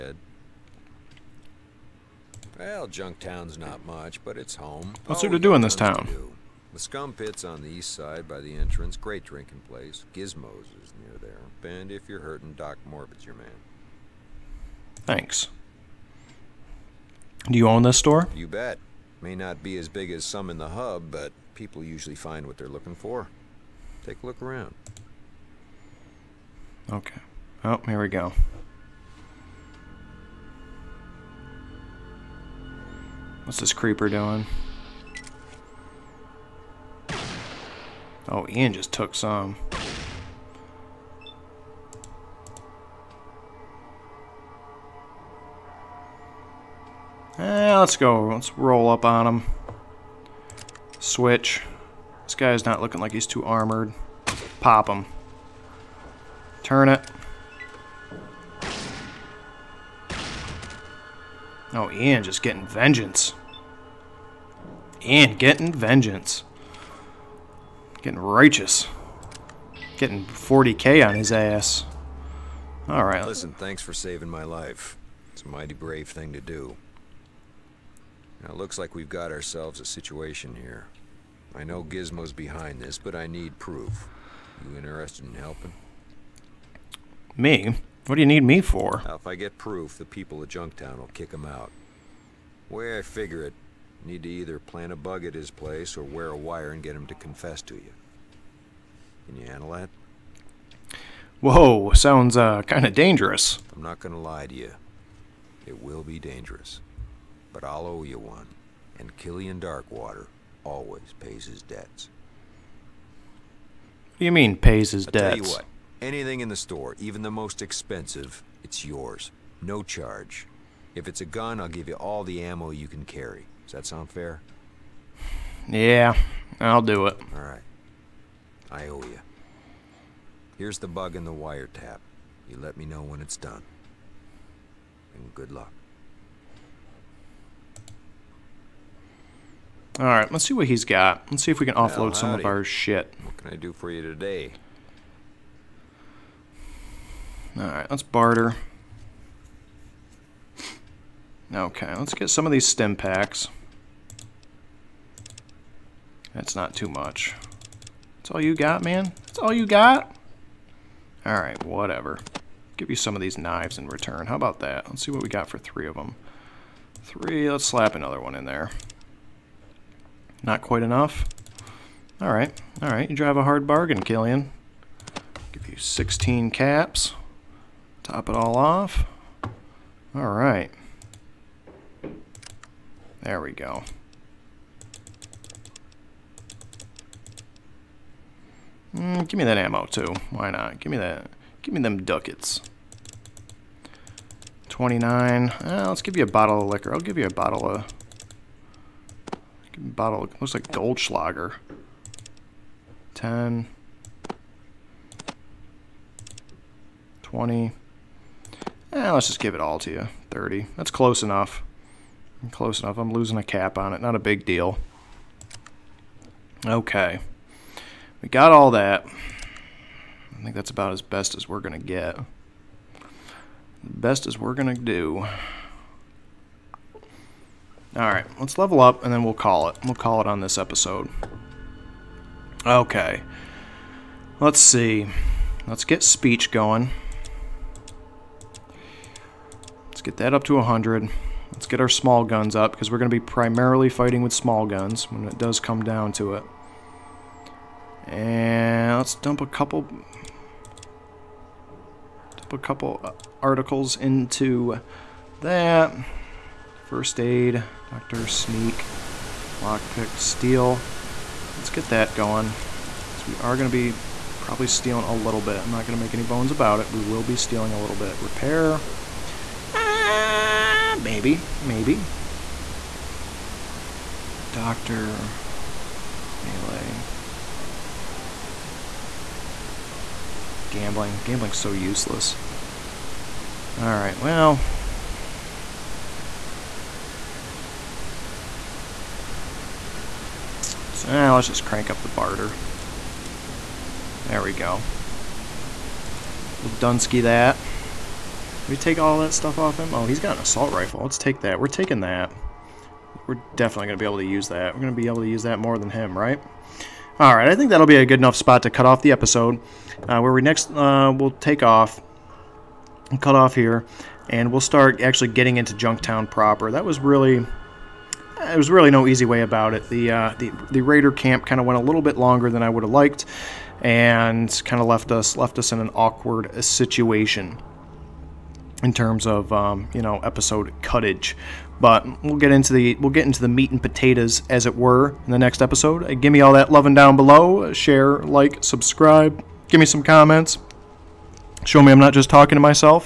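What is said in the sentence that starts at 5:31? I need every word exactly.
But we'll get into the we'll get into the meat and potatoes, as it were, in the next episode.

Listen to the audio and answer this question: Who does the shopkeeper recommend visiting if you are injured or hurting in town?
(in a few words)
Doc Morbid.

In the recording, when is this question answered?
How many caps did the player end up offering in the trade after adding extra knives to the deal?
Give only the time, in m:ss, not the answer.
2:55.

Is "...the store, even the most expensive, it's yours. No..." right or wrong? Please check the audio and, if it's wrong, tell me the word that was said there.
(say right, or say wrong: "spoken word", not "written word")
right.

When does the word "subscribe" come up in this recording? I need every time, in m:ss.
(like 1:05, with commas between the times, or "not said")
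5:38.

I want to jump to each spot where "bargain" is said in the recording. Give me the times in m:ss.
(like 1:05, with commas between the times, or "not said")
2:53.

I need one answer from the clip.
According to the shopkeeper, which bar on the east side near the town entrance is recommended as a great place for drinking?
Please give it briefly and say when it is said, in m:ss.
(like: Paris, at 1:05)
The Scum Pit, at 0:06.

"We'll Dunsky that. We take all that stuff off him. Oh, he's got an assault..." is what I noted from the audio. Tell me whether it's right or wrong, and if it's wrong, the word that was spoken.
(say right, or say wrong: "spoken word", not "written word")
right.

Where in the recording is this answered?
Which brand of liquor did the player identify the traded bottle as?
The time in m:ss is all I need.
3:20.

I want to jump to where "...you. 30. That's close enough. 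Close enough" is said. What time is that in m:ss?
3:29.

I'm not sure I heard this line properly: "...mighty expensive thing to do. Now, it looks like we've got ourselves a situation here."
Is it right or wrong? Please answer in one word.
wrong.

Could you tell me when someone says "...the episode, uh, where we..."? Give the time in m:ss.
5:09.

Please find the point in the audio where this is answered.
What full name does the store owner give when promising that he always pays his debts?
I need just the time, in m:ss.
1:49.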